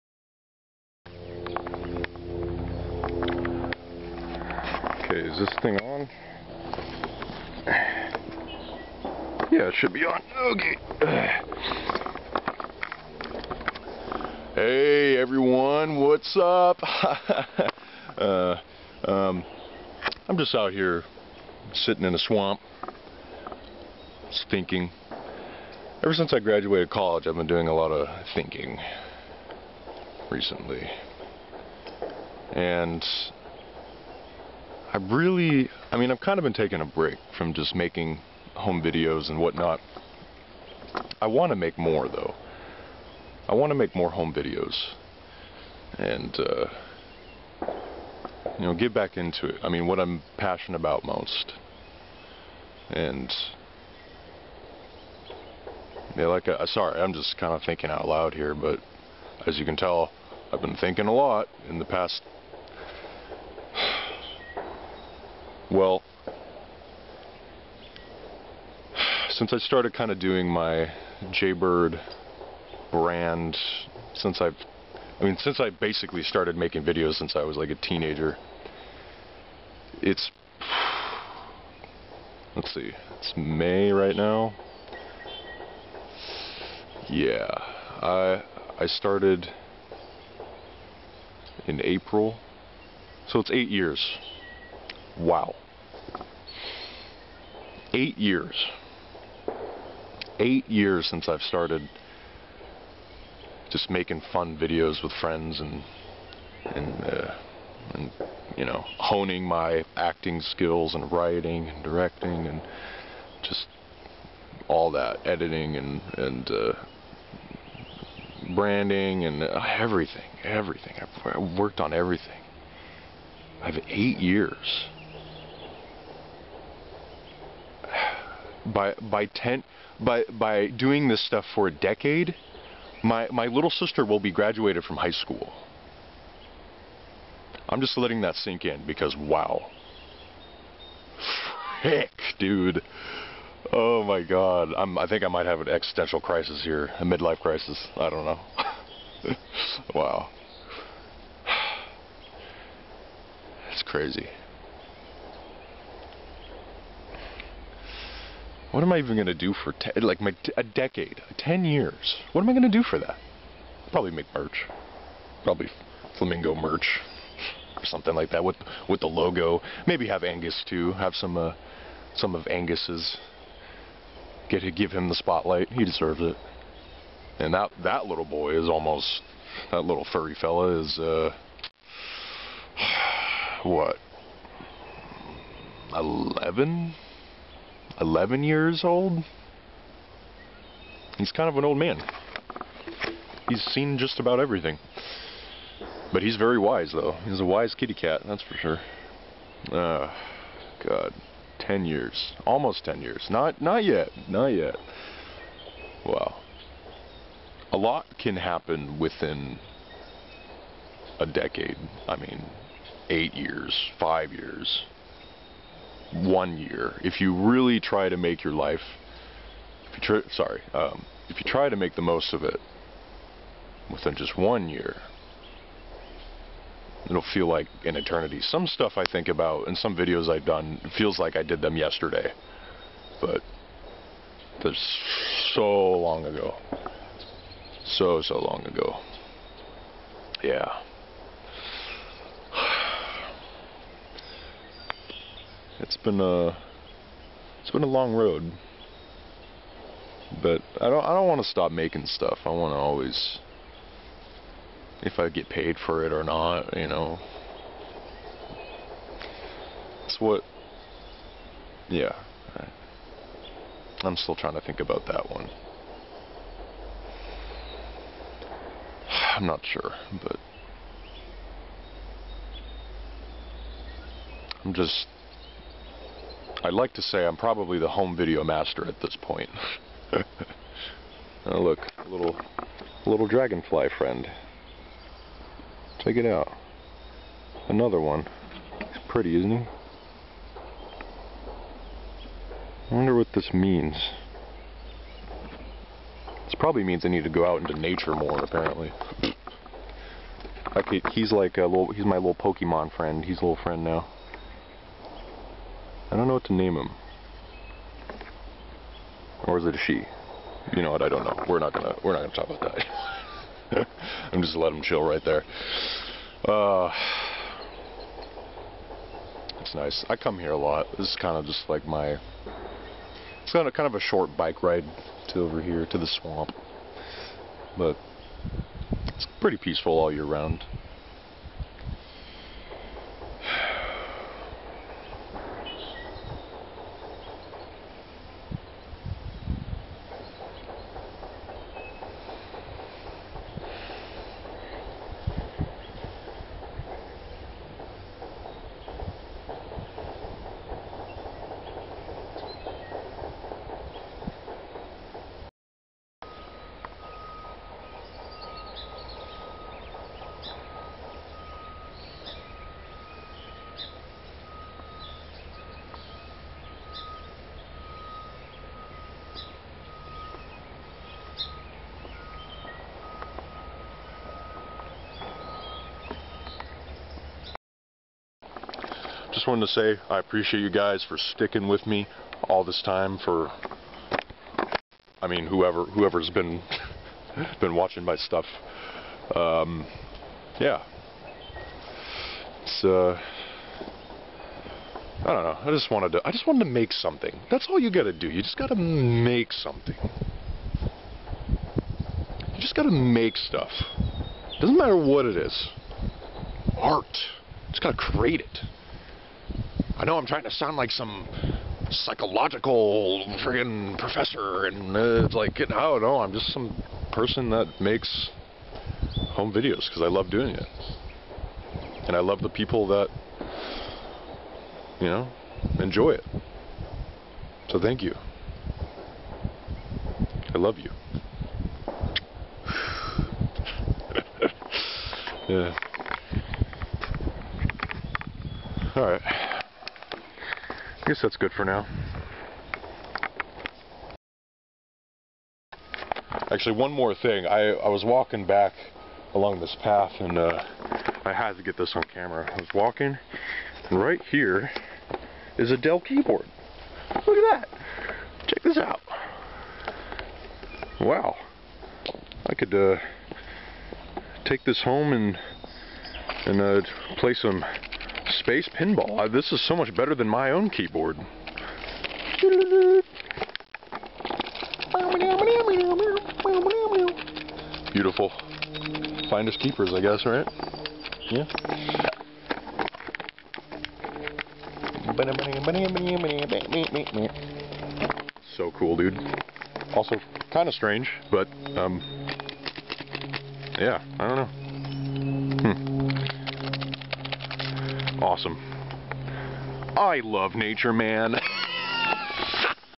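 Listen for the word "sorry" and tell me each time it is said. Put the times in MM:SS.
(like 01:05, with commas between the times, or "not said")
00:56, 03:40.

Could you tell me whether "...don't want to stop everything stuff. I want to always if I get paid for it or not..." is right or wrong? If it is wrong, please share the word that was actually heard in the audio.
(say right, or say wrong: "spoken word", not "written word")
wrong: "making", not "everything".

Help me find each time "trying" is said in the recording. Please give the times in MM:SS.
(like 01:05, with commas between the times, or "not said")
04:24, 06:50.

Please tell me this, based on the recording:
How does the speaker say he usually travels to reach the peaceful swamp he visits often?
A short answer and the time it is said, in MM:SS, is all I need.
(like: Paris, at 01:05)
Bike ride, at 05:24.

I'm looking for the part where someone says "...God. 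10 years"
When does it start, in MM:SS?
03:20.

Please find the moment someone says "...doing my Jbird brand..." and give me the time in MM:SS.
01:10.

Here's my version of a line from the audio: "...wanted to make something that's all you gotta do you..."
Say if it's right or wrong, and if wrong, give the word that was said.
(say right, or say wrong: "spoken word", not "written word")
right.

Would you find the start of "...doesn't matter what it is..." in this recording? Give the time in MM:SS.
06:44.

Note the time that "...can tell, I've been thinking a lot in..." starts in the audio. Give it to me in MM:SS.
00:59.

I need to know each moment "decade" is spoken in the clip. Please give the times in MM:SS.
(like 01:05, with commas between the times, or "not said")
02:11, 02:40, 03:31.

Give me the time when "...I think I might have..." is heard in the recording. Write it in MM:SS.
02:24.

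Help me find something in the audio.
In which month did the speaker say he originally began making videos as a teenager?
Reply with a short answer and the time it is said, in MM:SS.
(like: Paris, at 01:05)
April, at 01:31.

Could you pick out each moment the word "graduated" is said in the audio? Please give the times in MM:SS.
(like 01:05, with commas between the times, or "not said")
00:26, 02:14.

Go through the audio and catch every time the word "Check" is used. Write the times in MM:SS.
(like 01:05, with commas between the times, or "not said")
04:46, 07:38.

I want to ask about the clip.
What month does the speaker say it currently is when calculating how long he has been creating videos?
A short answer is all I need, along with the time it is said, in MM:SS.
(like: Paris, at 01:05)
May, at 01:23.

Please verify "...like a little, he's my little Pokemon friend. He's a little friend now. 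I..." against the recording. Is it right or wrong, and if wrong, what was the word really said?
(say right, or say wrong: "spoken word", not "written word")
right.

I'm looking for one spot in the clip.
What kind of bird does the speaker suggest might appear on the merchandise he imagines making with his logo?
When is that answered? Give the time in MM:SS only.
02:46.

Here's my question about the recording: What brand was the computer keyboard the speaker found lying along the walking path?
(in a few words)
Dell.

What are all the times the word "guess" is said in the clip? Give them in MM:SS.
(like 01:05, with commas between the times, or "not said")
07:21, 08:00.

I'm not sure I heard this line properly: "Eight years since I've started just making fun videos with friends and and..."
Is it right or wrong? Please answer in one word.
right.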